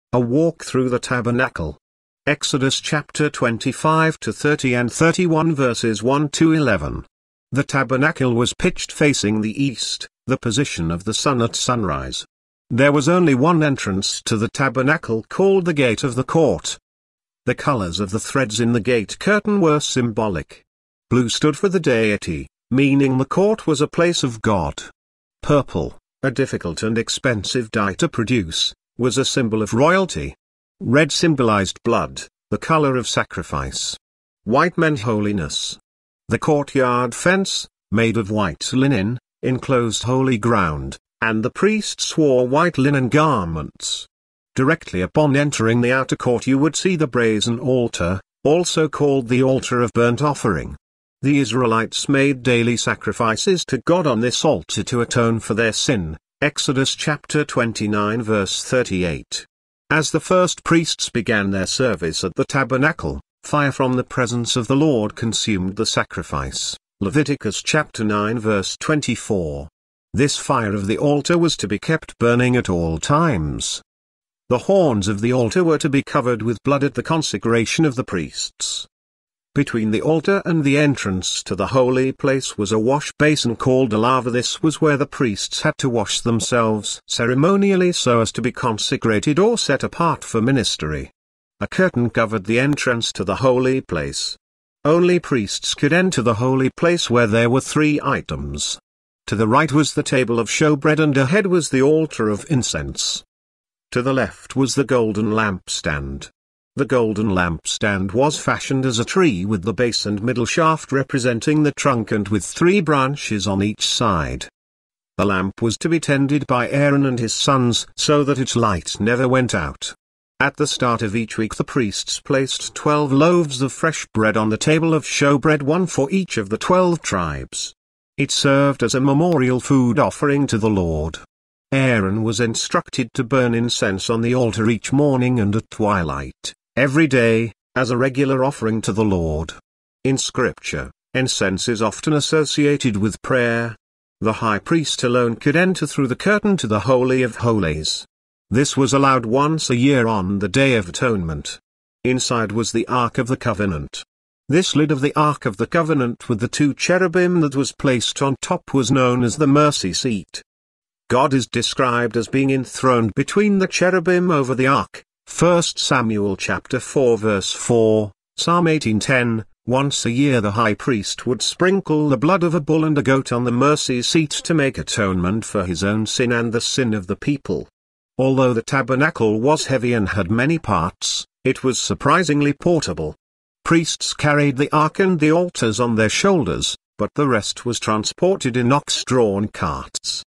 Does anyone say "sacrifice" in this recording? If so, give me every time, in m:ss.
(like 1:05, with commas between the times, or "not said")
0:33, 0:52, 1:05.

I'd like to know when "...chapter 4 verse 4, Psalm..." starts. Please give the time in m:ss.
2:46.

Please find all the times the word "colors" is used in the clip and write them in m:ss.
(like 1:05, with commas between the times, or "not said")
0:17, 0:32.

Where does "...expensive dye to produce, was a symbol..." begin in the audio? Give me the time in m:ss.
0:26.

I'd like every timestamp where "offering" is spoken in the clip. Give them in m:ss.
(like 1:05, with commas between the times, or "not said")
0:50, 2:09, 2:18.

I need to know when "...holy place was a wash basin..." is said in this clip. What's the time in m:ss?
1:21.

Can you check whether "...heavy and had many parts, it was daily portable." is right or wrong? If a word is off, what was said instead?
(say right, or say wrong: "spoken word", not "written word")
wrong: "surprisingly", not "daily".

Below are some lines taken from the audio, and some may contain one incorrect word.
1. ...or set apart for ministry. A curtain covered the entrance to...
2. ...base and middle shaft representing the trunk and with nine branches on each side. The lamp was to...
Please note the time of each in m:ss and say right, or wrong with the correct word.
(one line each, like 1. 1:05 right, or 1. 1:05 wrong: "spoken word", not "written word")
1. 1:29 right
2. 1:49 wrong: "three", not "nine".